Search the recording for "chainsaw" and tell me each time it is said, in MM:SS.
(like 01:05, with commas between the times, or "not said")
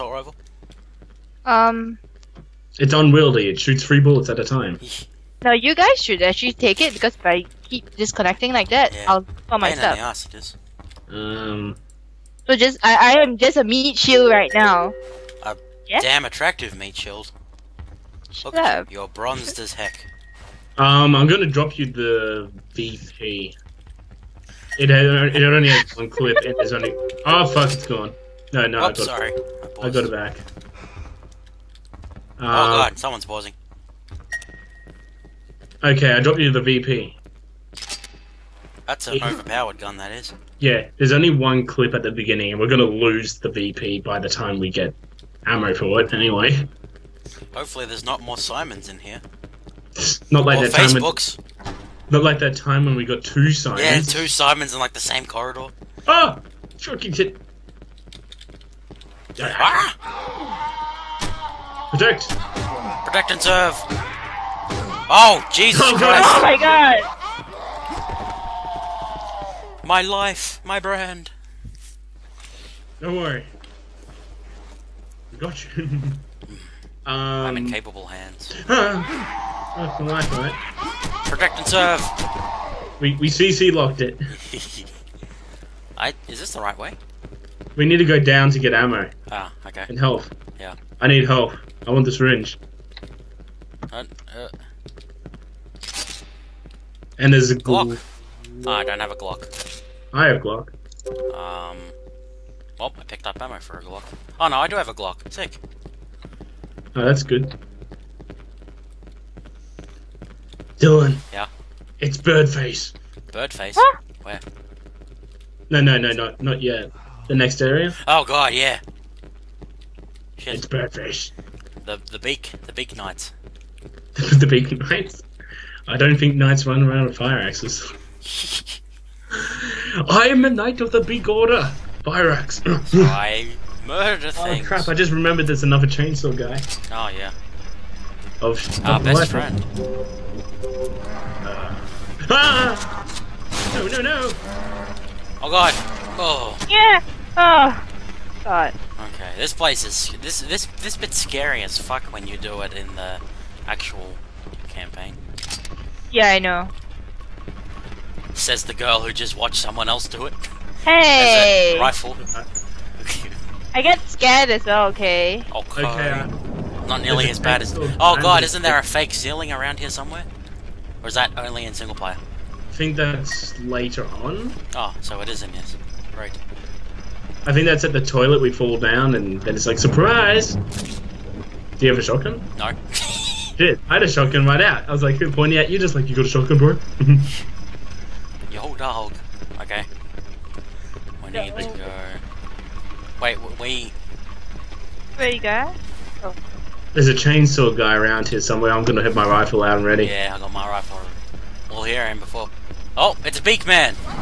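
02:15, 03:17.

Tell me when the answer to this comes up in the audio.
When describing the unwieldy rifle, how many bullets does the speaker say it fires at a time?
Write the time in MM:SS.
00:03.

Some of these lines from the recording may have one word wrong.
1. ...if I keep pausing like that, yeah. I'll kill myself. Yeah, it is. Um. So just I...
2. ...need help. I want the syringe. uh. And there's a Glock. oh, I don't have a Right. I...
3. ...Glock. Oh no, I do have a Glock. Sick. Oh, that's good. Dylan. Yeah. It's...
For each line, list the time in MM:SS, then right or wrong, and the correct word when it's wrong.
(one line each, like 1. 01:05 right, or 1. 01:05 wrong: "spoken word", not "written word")
1. 00:07 wrong: "disconnecting", not "pausing"
2. 01:31 wrong: "Glock", not "Right"
3. 01:43 right.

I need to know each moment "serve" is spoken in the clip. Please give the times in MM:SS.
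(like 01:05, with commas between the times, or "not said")
01:03, 01:21.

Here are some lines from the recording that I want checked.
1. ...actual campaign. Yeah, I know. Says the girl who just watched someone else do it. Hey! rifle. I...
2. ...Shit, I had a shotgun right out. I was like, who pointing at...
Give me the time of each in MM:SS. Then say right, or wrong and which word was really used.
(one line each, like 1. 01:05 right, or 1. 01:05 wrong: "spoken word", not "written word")
1. 02:33 right
2. 03:02 right.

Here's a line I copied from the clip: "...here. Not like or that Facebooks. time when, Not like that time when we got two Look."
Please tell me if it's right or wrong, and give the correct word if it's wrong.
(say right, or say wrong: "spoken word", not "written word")
wrong: "Simons", not "Look".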